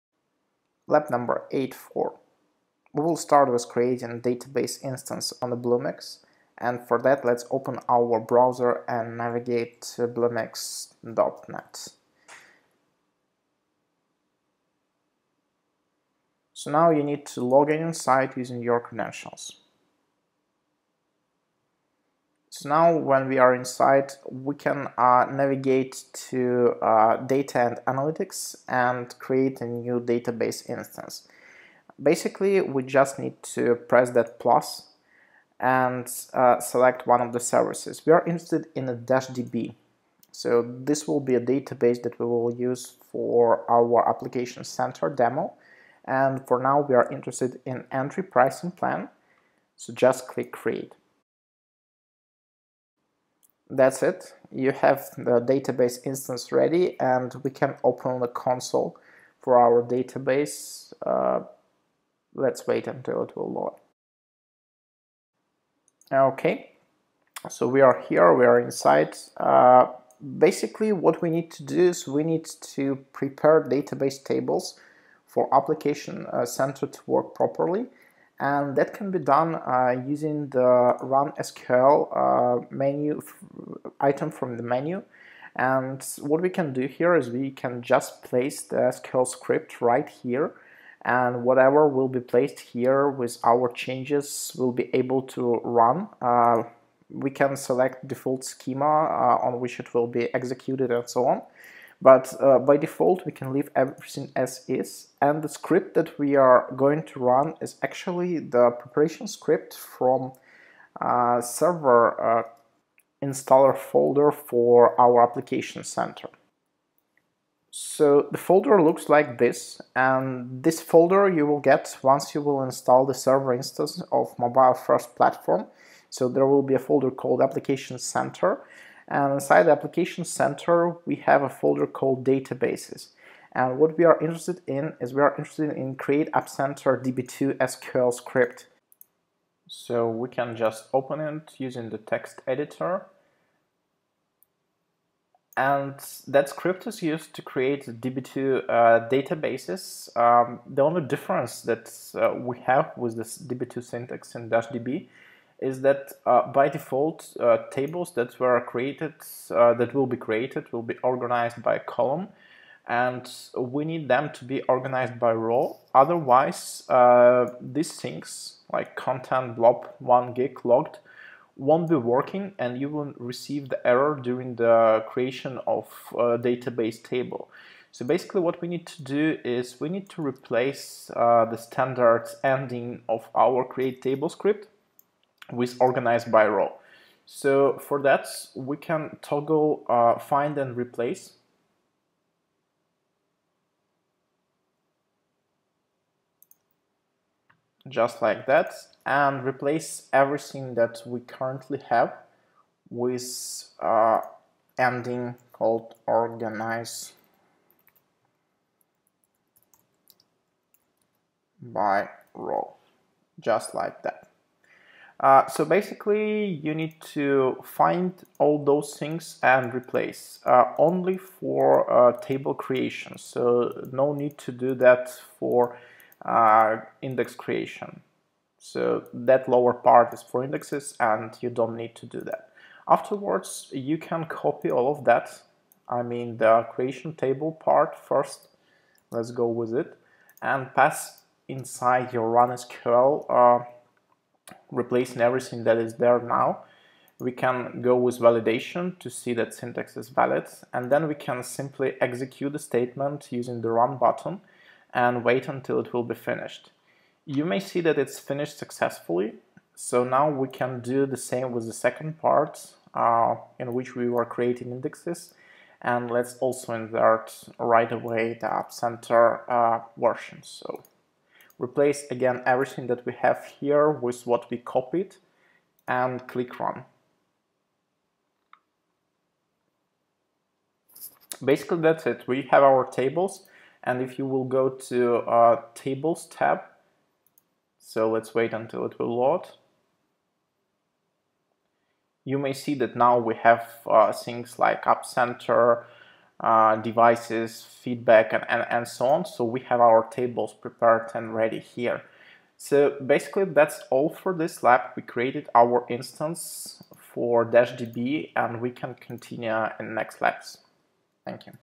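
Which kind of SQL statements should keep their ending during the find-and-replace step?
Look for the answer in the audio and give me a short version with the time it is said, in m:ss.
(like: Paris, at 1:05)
Index creation, at 3:47.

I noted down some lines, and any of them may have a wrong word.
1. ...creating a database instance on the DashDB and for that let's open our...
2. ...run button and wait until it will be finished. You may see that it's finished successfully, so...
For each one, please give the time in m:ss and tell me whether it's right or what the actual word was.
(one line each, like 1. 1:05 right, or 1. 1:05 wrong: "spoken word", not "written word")
1. 0:03 wrong: "Bluemix", not "DashDB"
2. 4:13 right.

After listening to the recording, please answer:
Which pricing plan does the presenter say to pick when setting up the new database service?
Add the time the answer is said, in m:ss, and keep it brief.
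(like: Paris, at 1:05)
Entry, at 0:47.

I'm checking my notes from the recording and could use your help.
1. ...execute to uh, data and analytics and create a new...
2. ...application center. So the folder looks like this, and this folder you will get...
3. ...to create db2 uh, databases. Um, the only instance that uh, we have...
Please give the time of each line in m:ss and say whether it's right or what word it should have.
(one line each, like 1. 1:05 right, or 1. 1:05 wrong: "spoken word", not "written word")
1. 0:25 wrong: "navigate", not "execute"
2. 1:55 right
3. 2:27 wrong: "difference", not "instance".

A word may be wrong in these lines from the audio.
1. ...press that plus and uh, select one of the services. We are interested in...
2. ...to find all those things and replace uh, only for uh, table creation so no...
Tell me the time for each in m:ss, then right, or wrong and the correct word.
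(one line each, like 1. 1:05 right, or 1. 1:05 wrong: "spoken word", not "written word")
1. 0:33 right
2. 3:36 right.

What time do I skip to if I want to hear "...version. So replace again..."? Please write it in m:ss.
4:29.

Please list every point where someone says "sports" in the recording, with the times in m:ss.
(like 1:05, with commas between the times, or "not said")
not said.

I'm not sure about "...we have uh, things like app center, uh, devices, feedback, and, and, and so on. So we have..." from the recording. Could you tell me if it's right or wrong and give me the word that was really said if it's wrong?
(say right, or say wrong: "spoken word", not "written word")
right.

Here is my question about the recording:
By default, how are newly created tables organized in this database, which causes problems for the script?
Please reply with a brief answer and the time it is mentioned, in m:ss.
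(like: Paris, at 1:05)
By column, at 2:41.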